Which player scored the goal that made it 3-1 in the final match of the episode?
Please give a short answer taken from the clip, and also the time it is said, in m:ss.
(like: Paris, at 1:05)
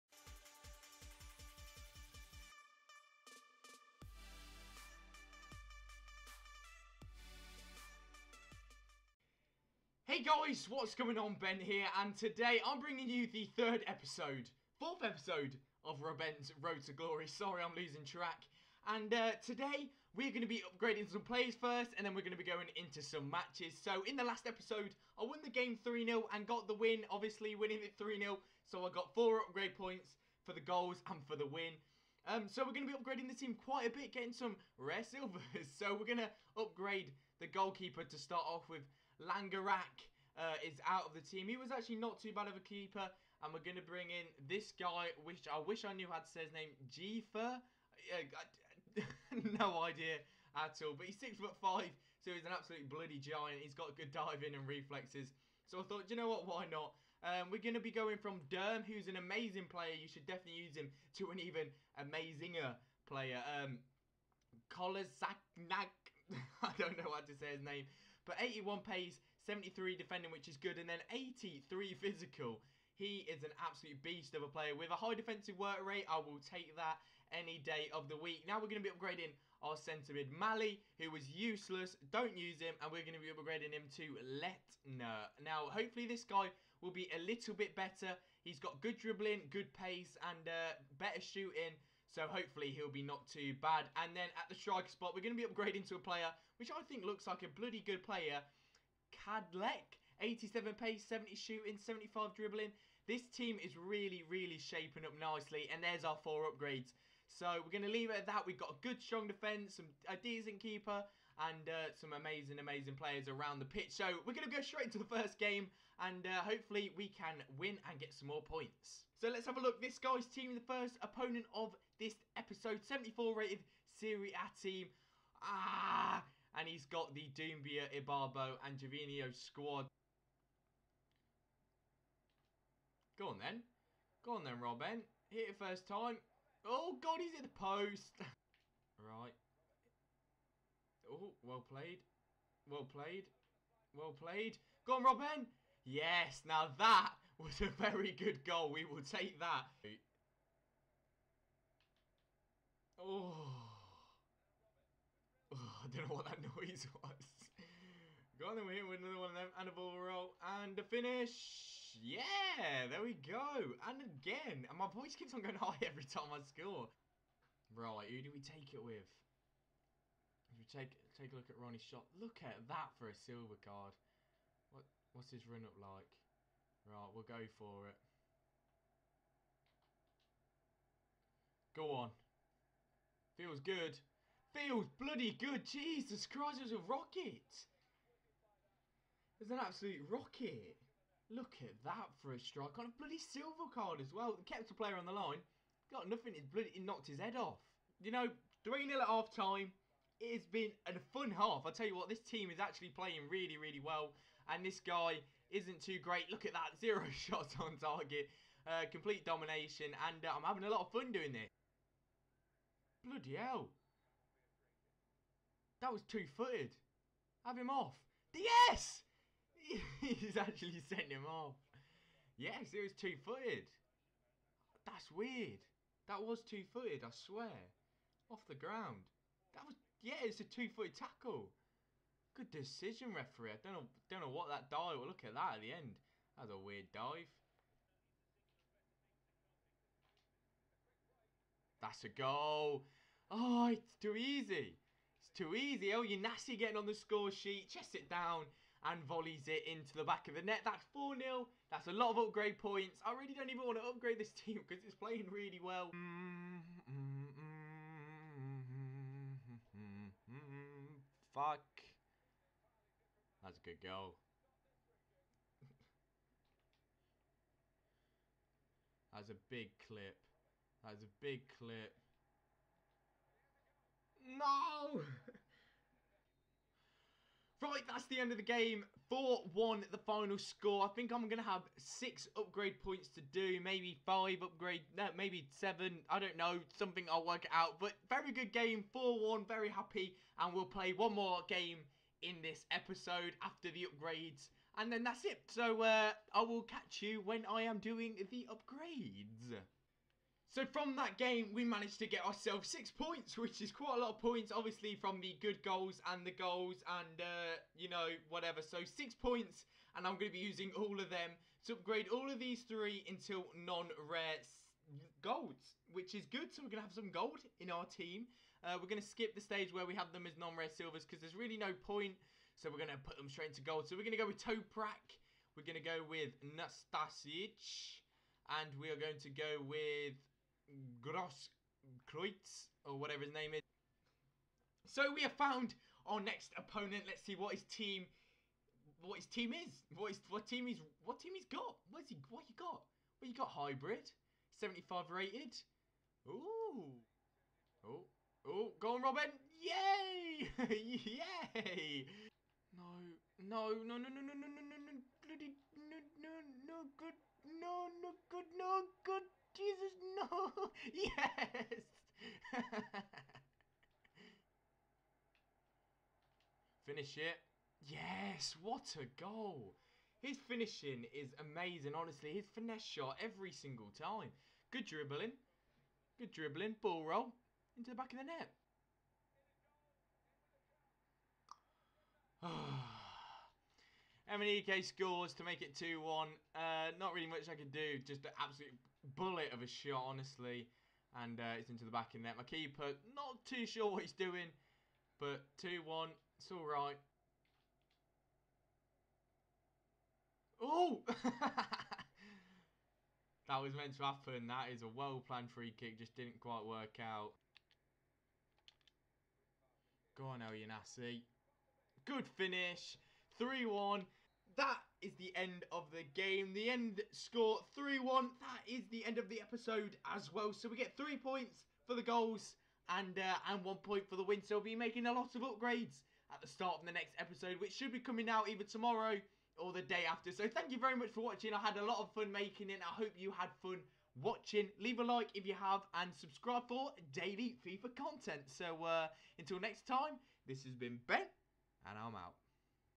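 El Yanassi, at 6:50.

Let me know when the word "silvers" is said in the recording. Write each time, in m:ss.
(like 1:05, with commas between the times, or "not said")
0:35, 2:53, 3:13, 5:20.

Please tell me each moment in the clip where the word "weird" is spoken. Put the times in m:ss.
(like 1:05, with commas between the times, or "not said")
3:45, 3:56.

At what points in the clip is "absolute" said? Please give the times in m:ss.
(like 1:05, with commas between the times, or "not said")
0:52, 1:13, 3:09, 6:28.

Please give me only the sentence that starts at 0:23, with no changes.
So, in the last episode, I won the game 3-0 and got the win, obviously winning it 3-0.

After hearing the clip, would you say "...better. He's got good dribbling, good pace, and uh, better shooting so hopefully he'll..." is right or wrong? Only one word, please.
right.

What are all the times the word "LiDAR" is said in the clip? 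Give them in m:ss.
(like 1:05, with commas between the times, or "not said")
not said.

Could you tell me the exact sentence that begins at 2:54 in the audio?
What what's his run up like?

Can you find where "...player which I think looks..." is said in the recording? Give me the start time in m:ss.
1:36.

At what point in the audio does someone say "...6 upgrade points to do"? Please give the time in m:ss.
4:41.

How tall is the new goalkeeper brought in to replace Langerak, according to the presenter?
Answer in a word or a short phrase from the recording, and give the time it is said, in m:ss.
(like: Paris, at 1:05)
six foot five, at 0:51.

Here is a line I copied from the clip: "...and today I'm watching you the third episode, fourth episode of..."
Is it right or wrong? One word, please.
wrong.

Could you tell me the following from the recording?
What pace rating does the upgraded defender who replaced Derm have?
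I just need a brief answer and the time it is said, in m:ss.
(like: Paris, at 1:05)
81, at 1:08.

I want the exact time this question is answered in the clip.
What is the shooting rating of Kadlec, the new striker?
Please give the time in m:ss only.
1:41.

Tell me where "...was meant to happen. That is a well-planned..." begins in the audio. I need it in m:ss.
6:43.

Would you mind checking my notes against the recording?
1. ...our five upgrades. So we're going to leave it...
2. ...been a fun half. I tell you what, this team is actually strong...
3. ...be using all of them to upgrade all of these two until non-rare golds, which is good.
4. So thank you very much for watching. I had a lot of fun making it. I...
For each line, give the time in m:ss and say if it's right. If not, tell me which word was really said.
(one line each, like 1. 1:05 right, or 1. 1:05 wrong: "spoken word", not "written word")
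1. 1:46 wrong: "four", not "five"
2. 3:20 wrong: "playing", not "strong"
3. 5:10 wrong: "three", not "two"
4. 7:10 right.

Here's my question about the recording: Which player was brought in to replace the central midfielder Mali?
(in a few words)
Letner.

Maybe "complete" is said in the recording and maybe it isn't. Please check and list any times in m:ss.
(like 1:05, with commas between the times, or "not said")
3:28.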